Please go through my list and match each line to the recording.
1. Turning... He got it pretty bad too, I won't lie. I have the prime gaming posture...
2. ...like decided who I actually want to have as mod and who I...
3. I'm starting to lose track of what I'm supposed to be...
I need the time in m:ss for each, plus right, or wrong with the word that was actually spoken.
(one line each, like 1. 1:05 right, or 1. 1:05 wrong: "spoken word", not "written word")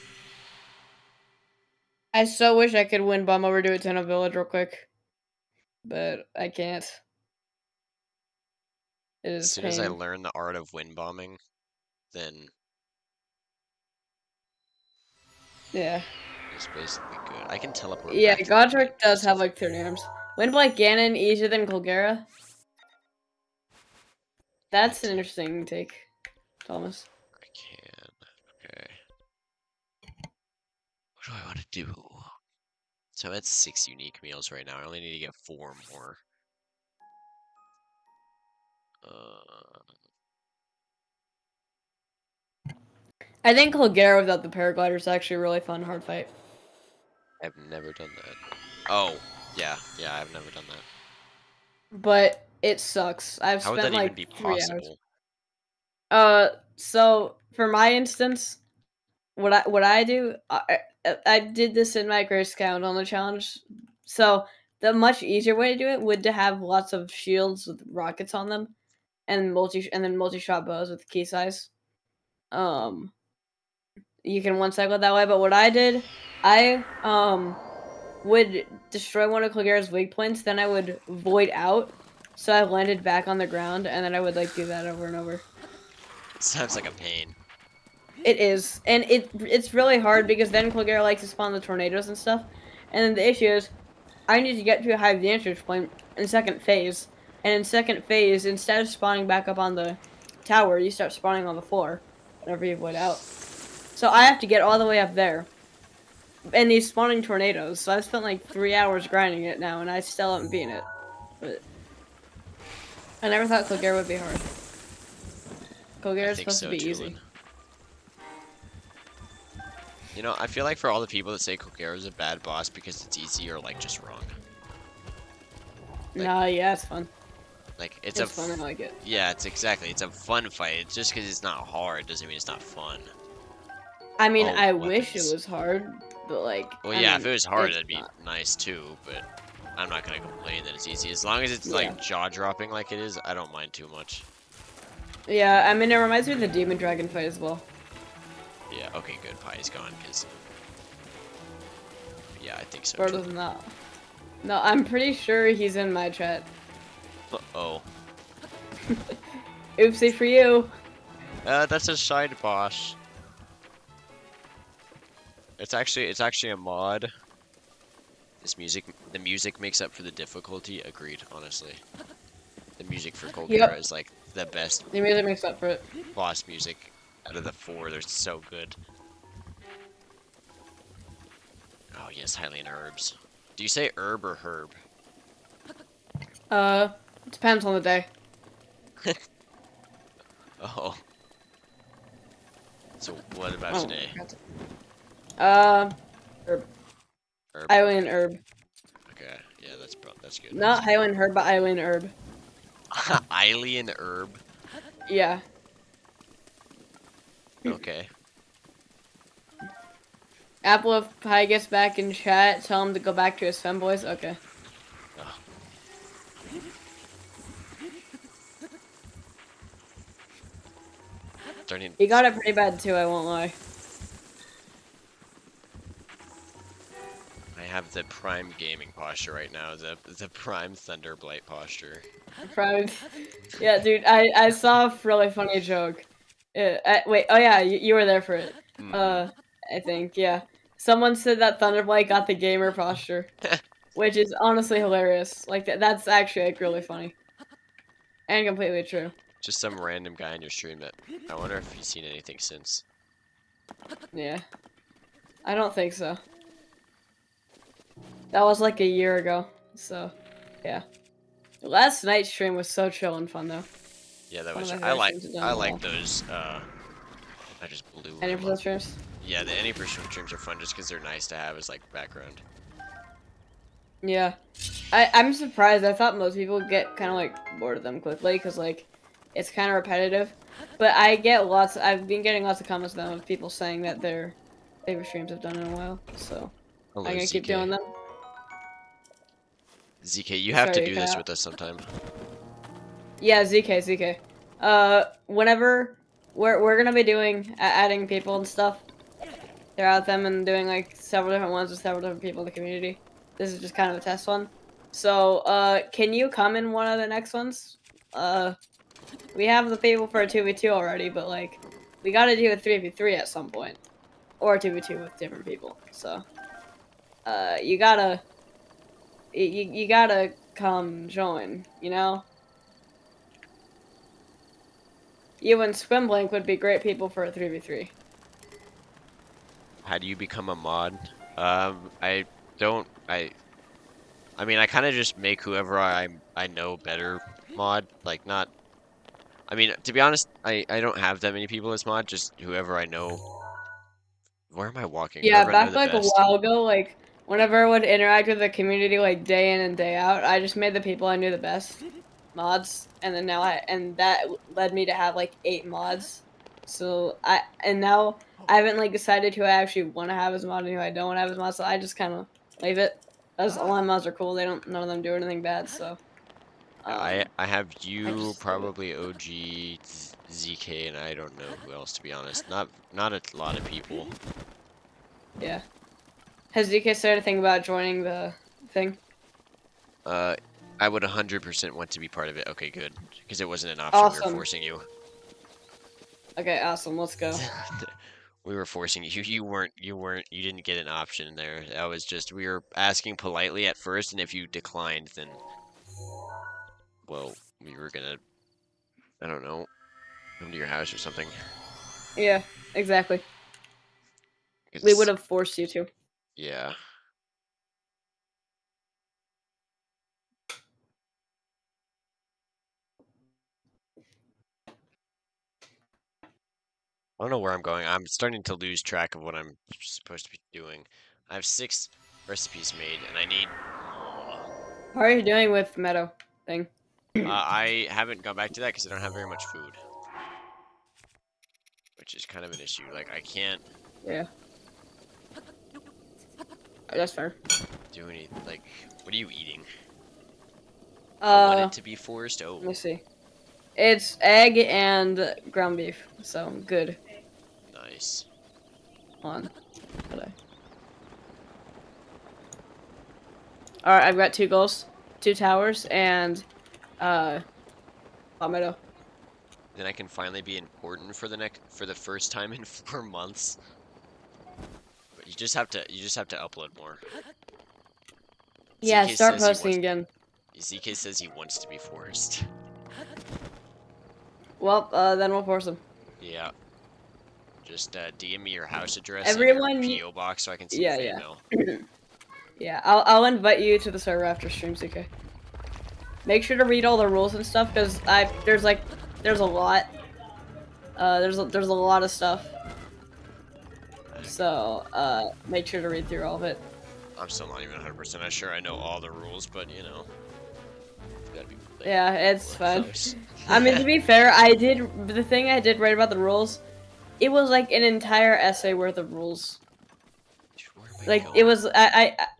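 1. 3:41 right
2. 5:58 right
3. 6:57 right.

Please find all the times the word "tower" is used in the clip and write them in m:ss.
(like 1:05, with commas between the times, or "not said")
1:40, 7:35.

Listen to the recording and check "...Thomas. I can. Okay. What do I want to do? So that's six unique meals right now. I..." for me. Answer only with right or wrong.
right.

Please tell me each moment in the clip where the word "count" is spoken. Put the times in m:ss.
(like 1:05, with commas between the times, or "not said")
1:02.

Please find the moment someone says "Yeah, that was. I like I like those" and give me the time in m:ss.
4:24.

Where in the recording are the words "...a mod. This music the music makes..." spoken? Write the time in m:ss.
2:46.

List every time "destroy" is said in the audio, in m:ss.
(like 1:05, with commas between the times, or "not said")
1:18.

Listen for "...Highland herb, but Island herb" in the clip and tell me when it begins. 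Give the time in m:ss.
3:20.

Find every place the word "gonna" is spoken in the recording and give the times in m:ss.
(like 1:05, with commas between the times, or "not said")
2:20, 4:47, 4:56, 6:37.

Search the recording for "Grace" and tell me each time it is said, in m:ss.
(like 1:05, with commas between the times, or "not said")
1:02.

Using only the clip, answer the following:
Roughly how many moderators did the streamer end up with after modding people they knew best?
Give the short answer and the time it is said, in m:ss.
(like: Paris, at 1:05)
8, at 5:55.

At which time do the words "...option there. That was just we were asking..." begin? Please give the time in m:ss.
6:30.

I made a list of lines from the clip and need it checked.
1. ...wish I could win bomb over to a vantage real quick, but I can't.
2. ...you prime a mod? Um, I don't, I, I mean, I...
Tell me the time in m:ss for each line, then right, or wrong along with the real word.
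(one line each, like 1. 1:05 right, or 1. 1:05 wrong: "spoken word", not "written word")
1. 0:02 wrong: "village", not "vantage"
2. 5:30 wrong: "become", not "prime".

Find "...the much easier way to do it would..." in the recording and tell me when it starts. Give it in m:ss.
1:04.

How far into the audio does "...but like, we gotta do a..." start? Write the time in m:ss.
5:11.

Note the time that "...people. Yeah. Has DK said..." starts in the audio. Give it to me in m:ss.
6:13.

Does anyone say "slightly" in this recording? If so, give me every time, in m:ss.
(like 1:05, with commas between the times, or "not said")
not said.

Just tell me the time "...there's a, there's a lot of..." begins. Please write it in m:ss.
8:11.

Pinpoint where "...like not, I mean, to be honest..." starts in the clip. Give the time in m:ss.
5:38.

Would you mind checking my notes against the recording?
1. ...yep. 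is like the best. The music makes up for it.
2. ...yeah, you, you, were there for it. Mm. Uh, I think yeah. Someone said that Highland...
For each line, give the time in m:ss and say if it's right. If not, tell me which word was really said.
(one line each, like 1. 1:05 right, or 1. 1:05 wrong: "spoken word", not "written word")
1. 2:53 right
2. 3:57 wrong: "Thunderblight", not "Highland".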